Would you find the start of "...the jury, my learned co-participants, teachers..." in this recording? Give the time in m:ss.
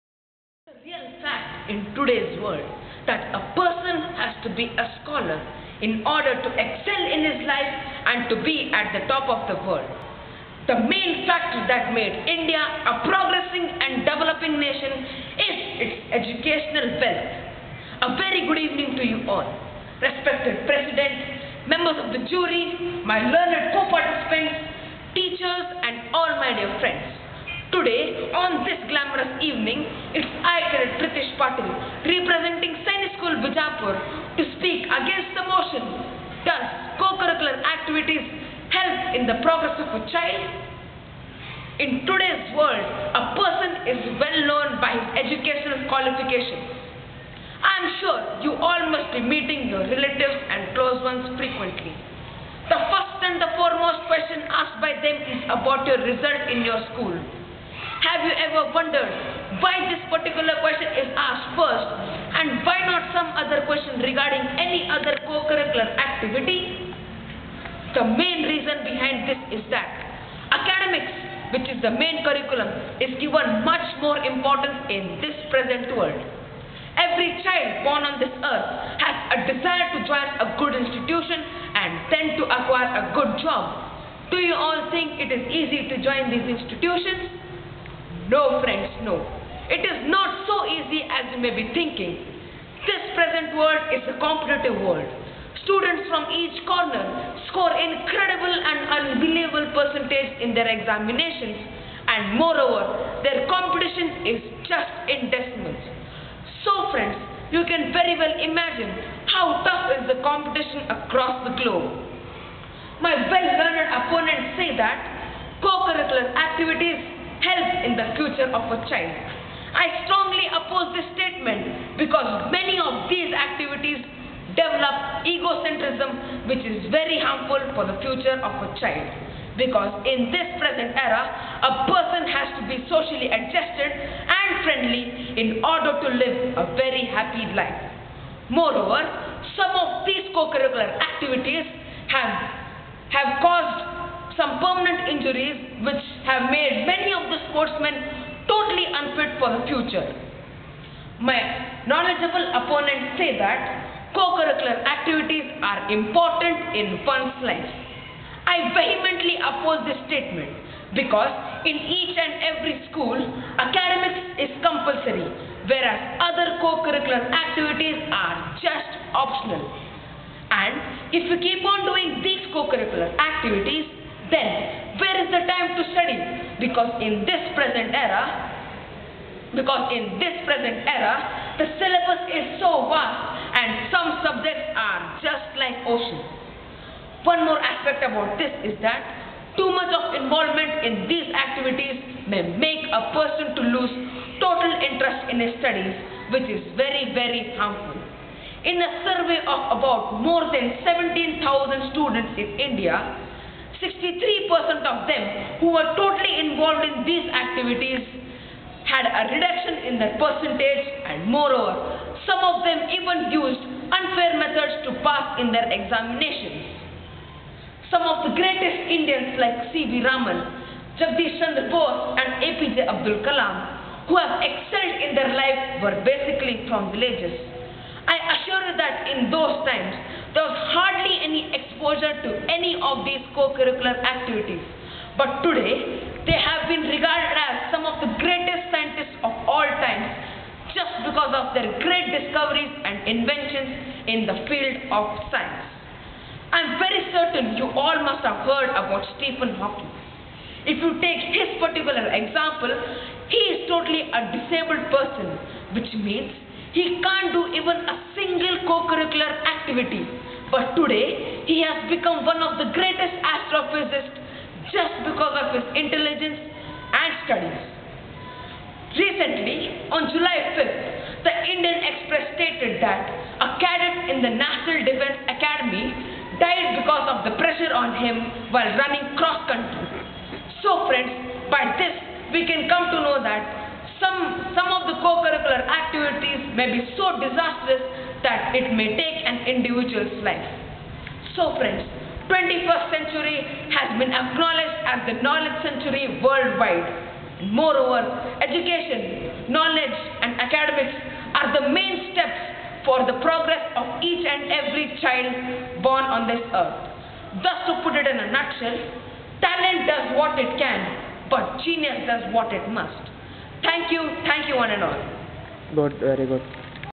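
0:22.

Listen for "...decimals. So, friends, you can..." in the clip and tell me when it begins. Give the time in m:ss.
1:45.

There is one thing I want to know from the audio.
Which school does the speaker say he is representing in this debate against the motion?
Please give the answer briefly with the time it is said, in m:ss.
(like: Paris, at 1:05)
Sainik School Bijapur, at 0:32.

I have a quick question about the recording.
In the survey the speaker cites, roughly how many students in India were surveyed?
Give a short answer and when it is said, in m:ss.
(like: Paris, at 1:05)
17,000, at 3:20.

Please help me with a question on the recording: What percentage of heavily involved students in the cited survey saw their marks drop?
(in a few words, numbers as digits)
63%.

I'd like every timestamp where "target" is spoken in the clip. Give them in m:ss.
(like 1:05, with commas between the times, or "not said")
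not said.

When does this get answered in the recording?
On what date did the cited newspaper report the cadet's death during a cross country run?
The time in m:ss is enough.
4:30.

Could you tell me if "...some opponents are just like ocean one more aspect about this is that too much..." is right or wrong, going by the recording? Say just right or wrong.
wrong.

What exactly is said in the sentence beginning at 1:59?
I strongly oppose this statement because many of these activities develop egocentrism which is very harmful for the future of a child.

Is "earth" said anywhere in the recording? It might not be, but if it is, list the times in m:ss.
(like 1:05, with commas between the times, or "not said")
1:18, 5:06.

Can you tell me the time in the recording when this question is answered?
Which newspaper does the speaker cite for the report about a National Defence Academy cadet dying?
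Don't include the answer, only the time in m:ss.
4:31.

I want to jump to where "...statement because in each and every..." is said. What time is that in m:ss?
2:40.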